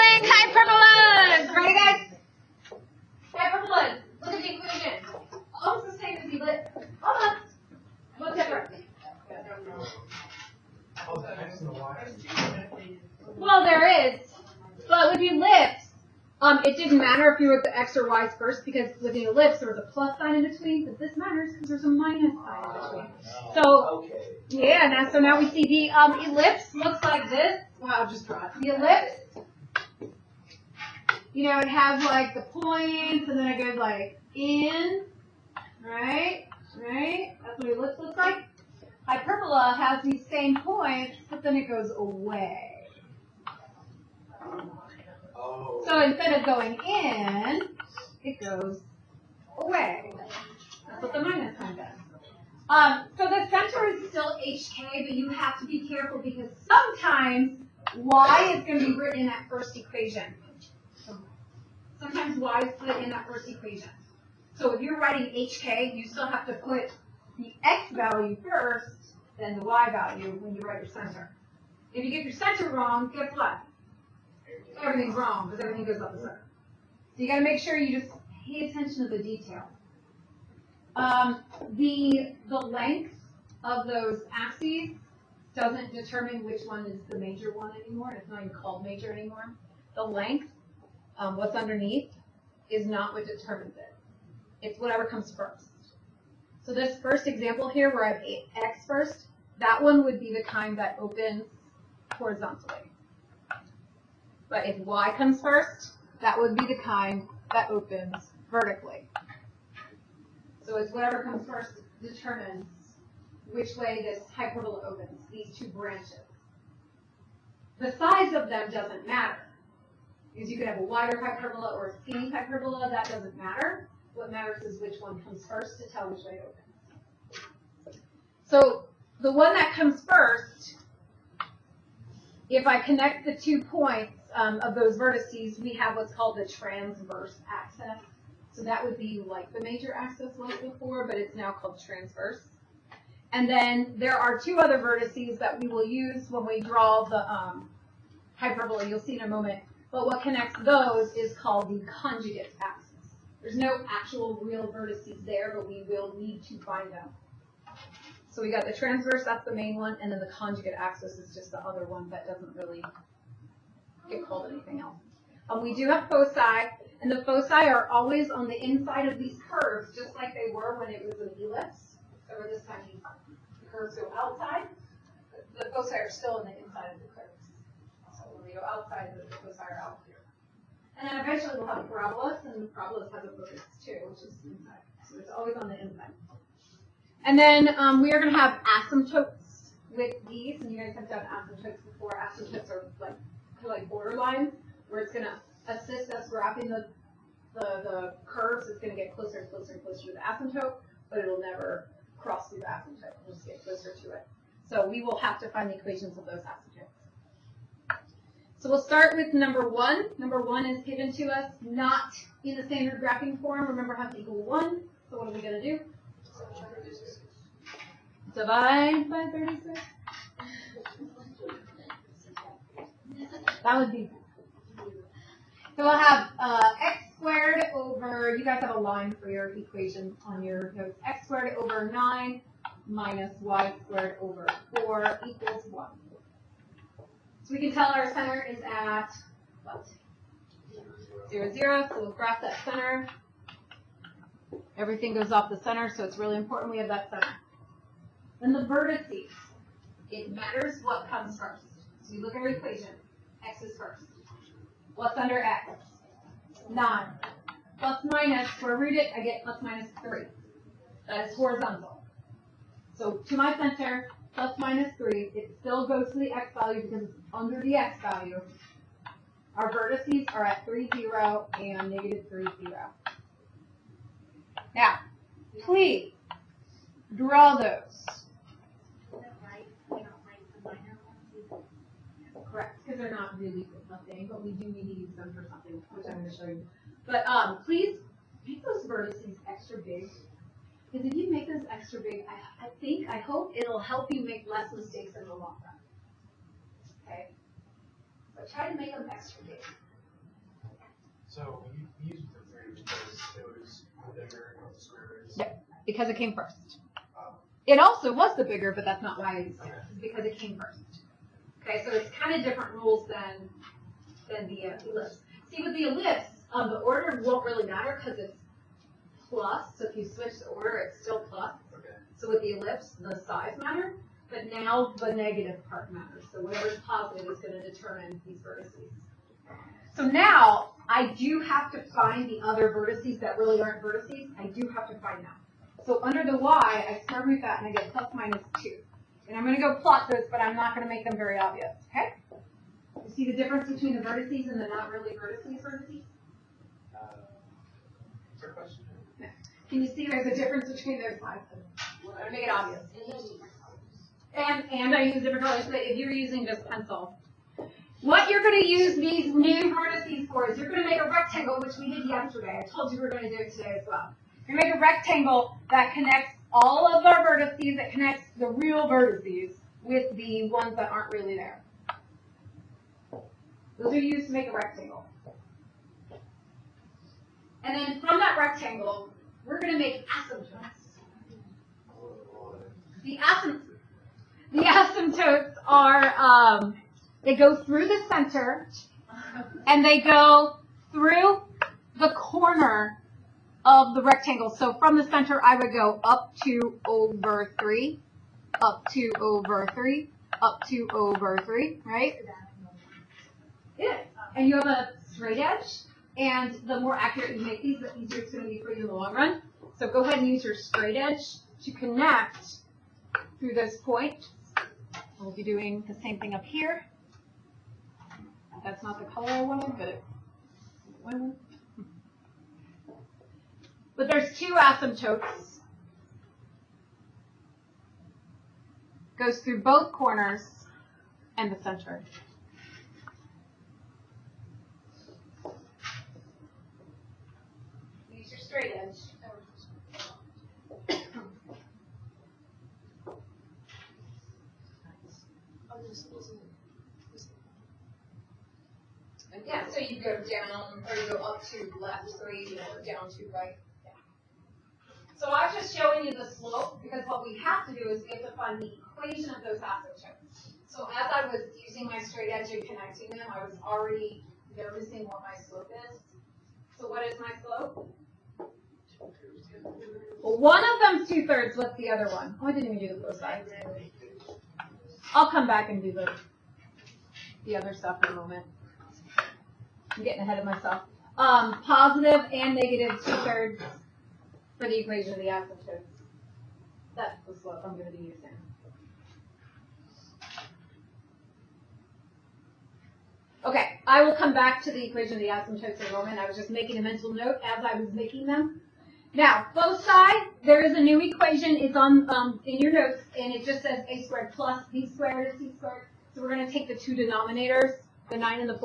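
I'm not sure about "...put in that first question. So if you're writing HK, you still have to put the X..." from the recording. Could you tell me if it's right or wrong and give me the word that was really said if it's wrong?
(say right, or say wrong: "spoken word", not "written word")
wrong: "equation", not "question".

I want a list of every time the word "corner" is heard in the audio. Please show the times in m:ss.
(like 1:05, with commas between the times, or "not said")
6:32, 7:09.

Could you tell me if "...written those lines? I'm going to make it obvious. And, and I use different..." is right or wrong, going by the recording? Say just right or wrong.
wrong.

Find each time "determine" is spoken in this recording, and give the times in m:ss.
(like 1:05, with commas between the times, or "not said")
1:25, 1:33, 1:52, 5:27.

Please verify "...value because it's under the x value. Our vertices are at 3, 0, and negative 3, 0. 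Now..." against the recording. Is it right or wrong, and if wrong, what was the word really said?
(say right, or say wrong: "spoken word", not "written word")
right.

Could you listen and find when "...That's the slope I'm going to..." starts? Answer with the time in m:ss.
8:06.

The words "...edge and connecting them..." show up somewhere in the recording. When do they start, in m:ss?
7:42.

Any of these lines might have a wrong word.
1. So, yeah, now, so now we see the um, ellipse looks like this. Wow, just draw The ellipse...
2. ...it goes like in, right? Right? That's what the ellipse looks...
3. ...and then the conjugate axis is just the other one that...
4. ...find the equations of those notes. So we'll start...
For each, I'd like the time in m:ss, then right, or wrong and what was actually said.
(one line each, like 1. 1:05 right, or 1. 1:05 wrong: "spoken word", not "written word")
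1. 0:23 right
2. 0:33 right
3. 2:40 right
4. 3:25 wrong: "asymptotes", not "notes".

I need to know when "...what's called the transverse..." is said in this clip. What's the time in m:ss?
2:15.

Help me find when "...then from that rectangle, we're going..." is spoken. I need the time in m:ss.
6:17.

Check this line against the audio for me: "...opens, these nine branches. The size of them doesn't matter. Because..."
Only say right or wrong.
wrong.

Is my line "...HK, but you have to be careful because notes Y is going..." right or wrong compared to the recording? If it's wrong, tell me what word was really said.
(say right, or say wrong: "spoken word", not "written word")
wrong: "sometimes", not "notes".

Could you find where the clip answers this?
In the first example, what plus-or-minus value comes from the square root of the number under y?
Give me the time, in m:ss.
5:37.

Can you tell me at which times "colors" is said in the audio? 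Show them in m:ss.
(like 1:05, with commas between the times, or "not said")
5:55, 6:59.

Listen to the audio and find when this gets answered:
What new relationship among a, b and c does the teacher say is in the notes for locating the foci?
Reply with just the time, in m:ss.
8:23.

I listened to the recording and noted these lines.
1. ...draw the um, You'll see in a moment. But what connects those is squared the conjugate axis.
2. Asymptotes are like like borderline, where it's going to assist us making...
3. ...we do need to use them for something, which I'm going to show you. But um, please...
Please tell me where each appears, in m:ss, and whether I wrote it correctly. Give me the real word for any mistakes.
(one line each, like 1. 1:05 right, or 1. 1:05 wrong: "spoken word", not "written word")
1. 2:26 wrong: "called", not "squared"
2. 3:12 wrong: "wrapping", not "making"
3. 4:44 right.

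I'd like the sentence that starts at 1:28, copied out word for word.
It's not even called major anymore.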